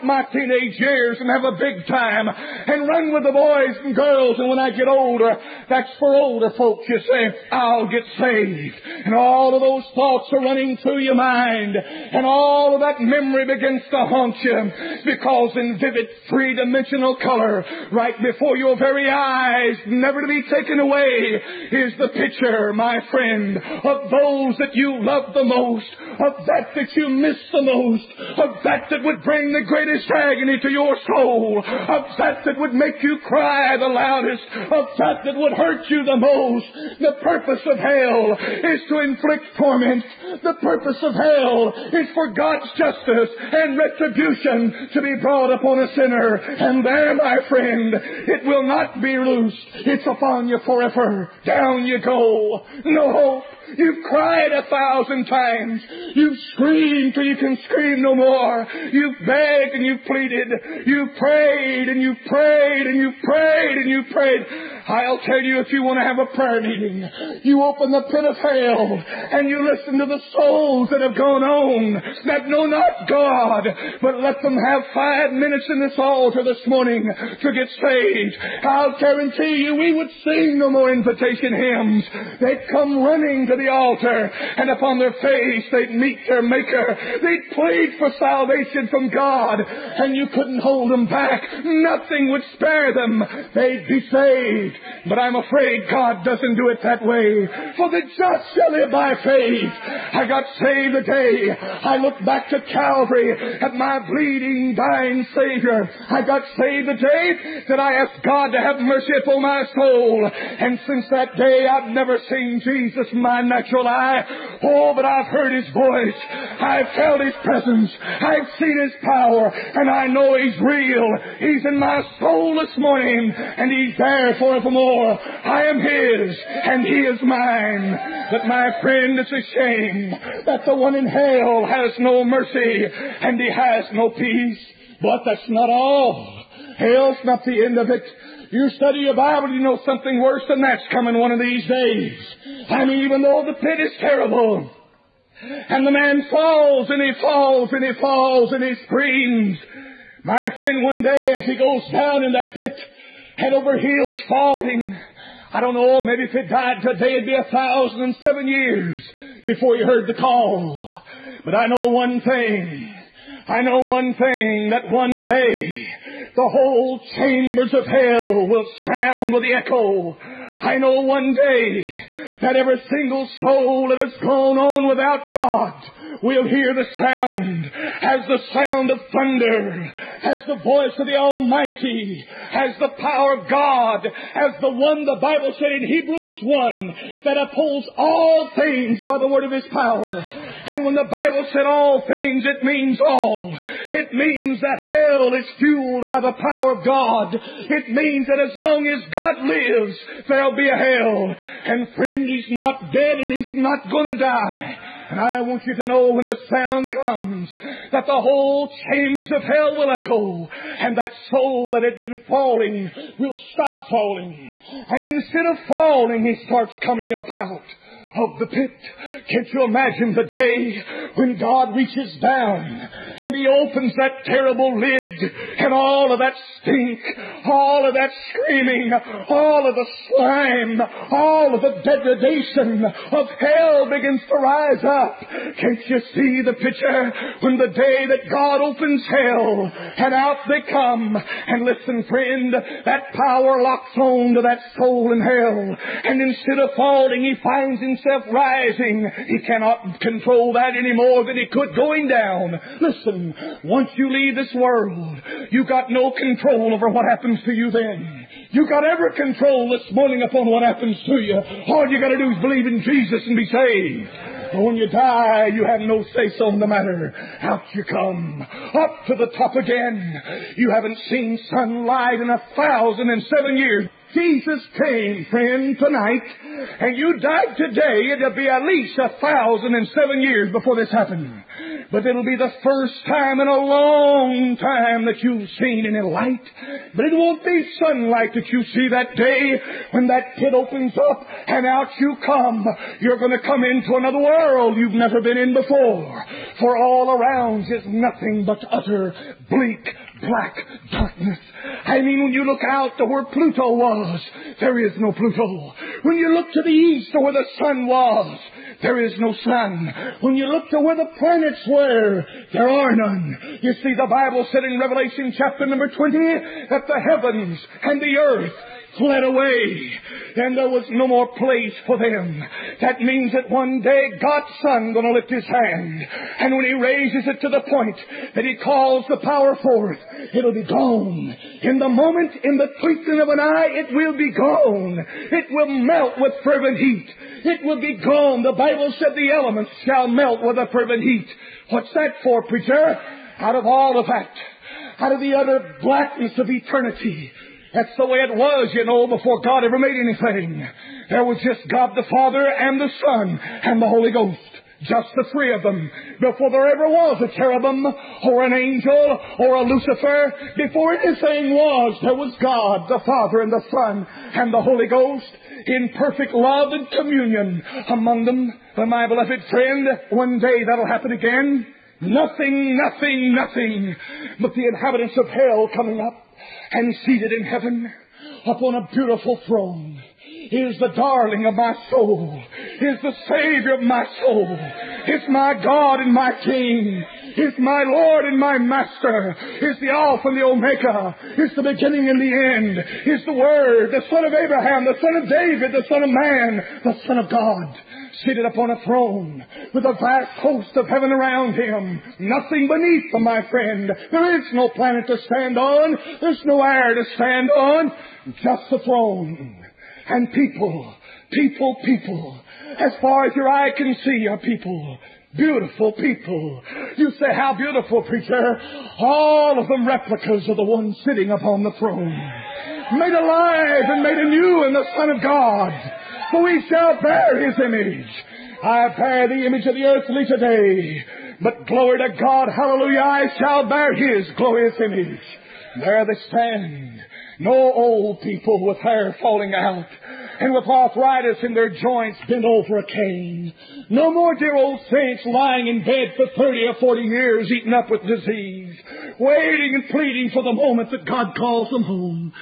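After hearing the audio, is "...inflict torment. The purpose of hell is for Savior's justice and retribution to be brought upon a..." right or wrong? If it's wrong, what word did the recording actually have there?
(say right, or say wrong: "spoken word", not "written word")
wrong: "God", not "Savior".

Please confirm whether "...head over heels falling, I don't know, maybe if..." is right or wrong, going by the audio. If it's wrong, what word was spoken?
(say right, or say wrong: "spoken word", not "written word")
right.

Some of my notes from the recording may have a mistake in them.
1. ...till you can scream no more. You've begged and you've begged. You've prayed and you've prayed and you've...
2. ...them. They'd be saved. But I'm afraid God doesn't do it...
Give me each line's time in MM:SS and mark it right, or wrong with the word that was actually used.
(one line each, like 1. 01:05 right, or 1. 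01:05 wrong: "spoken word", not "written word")
1. 00:57 wrong: "pleaded", not "begged"
2. 01:32 right.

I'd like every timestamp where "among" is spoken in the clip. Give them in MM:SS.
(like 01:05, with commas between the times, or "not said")
06:07.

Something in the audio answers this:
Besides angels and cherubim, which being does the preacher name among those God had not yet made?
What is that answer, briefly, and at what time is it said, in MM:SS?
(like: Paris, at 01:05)
Lucifer, at 05:59.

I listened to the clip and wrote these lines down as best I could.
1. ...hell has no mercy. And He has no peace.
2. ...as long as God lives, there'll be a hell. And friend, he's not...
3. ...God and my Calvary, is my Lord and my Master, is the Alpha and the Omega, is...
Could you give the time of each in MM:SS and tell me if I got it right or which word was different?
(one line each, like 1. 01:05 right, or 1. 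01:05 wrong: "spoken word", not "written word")
1. 02:11 right
2. 03:18 right
3. 06:25 wrong: "King", not "Calvary".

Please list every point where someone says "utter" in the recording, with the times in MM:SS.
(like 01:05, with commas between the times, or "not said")
04:58, 05:45.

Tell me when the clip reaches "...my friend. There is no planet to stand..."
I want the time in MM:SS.
06:43.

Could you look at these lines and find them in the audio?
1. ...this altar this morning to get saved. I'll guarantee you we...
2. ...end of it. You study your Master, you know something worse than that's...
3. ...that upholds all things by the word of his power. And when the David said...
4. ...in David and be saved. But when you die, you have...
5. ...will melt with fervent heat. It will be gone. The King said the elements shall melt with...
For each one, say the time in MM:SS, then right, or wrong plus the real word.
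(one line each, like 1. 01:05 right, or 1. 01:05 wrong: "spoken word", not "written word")
1. 01:15 right
2. 02:17 wrong: "Bible", not "Master"
3. 03:07 wrong: "Bible", not "David"
4. 04:22 wrong: "Jesus", not "David"
5. 05:35 wrong: "Bible", not "King".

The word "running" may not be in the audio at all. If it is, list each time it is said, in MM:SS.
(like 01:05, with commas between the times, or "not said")
00:10, 01:23.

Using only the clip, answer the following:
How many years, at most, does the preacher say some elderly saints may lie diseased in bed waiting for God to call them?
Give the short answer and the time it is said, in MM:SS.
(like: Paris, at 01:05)
40, at 07:26.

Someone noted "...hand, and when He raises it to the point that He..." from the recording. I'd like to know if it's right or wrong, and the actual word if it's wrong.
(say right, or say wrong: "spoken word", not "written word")
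right.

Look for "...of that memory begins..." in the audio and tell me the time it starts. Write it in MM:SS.
00:12.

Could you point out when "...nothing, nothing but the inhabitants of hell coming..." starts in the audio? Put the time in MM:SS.
06:12.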